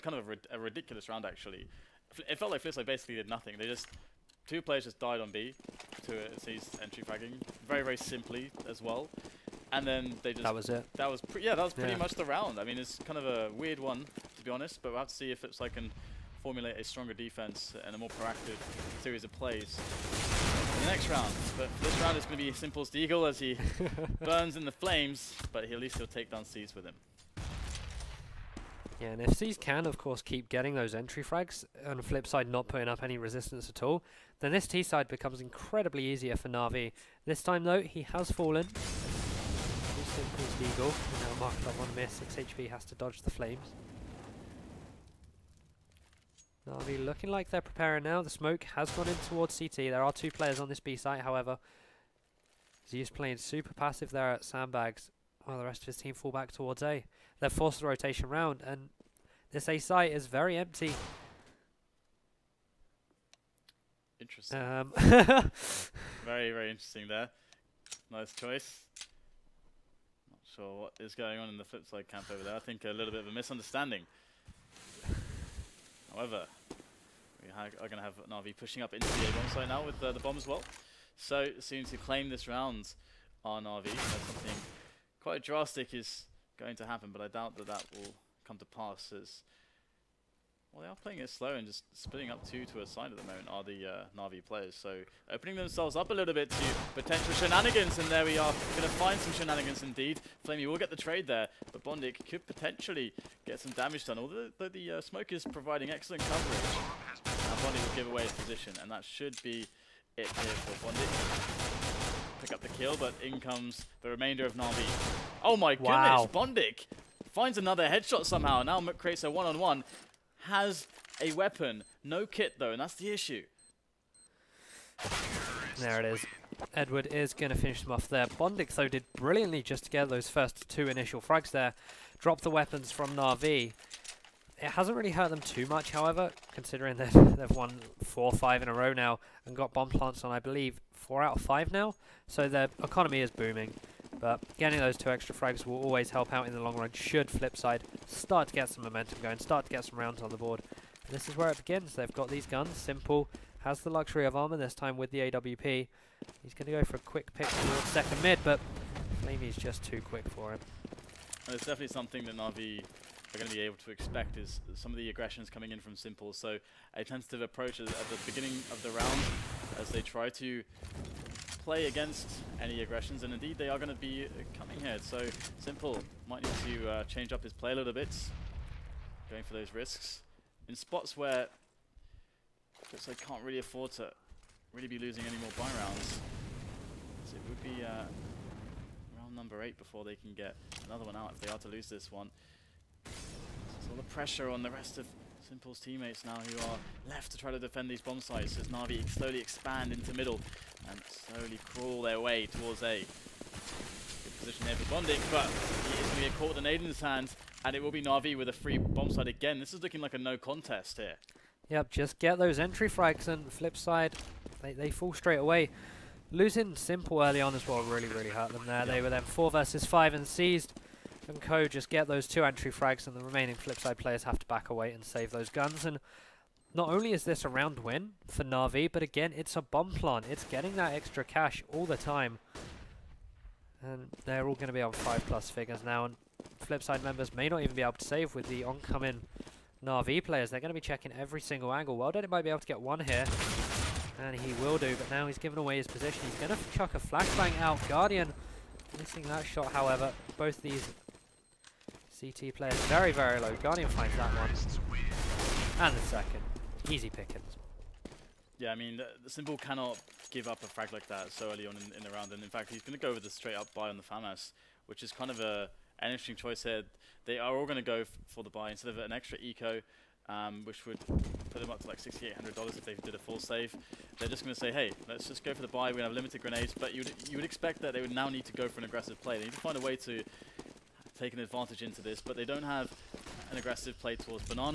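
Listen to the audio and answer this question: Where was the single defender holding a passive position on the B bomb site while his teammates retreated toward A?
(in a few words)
Sandbags.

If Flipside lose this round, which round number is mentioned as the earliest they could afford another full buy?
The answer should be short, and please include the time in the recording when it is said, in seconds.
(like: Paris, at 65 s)
8, at 189 s.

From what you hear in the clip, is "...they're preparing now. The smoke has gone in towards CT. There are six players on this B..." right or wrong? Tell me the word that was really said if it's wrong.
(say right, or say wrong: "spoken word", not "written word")
wrong: "two", not "six".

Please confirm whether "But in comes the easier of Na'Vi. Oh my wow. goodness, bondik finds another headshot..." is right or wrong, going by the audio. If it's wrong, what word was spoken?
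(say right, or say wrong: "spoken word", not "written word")
wrong: "remainder", not "easier".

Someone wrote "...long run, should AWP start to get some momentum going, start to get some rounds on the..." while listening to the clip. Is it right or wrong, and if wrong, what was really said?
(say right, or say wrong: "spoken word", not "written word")
wrong: "Flipside", not "AWP".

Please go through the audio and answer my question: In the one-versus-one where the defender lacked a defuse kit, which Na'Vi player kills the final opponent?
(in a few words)
Edward.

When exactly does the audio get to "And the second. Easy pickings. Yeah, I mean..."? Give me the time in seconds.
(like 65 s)
255 s.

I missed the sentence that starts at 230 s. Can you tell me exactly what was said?
It's getting that extra cash all the time.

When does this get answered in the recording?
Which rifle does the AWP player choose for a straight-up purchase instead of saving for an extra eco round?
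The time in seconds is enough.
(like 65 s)
264 s.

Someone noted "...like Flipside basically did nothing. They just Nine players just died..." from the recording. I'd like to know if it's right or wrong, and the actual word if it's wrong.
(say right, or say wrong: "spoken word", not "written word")
wrong: "Two", not "Nine".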